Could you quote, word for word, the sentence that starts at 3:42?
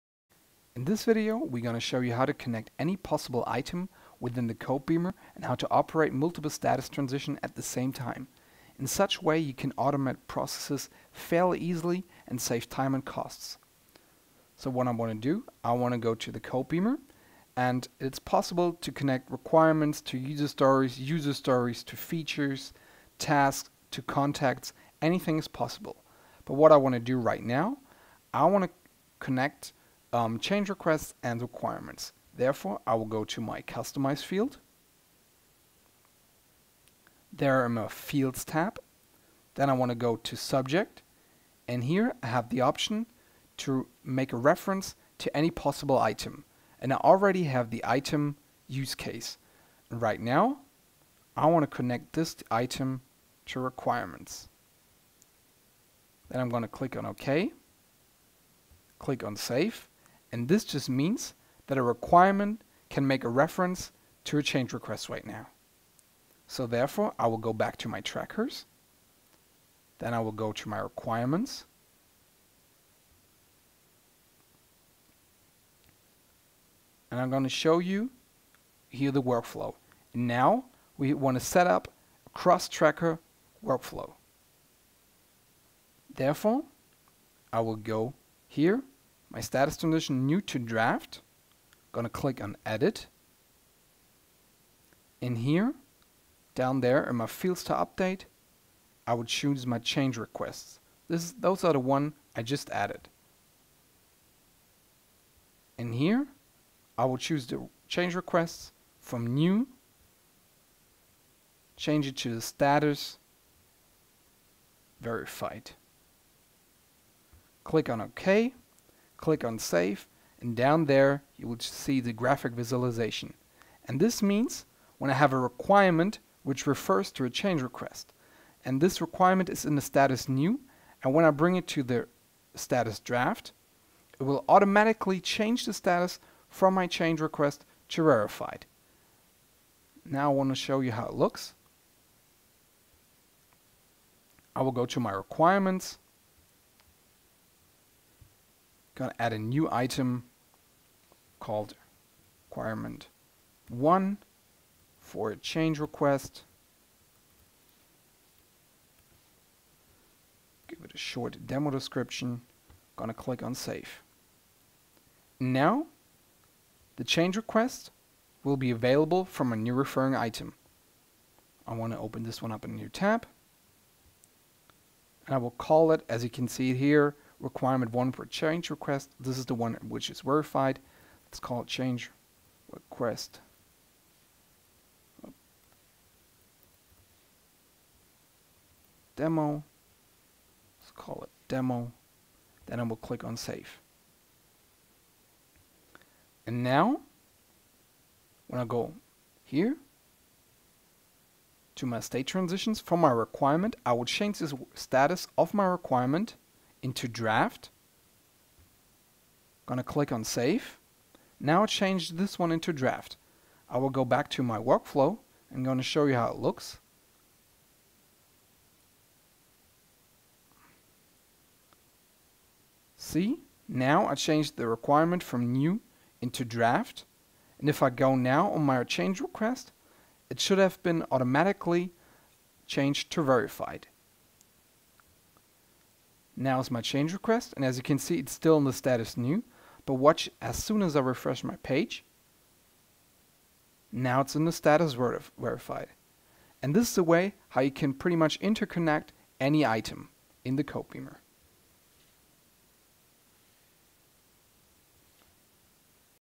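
See, now I changed the requirement from new into draft.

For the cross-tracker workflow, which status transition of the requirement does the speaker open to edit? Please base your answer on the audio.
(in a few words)
New to draft.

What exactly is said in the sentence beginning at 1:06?
So therefore, I will go back to my trackers.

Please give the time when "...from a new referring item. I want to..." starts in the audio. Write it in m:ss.
2:49.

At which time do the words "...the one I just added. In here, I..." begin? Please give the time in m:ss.
1:41.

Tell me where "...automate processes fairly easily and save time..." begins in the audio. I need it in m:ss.
0:09.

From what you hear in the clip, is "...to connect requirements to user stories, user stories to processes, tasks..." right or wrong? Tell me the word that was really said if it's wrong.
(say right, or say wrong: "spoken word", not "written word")
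wrong: "features", not "processes".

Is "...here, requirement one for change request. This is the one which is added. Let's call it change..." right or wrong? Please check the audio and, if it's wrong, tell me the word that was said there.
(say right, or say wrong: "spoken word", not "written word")
wrong: "verified", not "added".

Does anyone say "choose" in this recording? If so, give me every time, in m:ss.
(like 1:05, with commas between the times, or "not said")
1:39, 1:47.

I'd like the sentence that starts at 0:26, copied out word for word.
But what I want to do right now, I want to connect um, change requests and requirements.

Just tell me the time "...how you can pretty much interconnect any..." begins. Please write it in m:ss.
4:07.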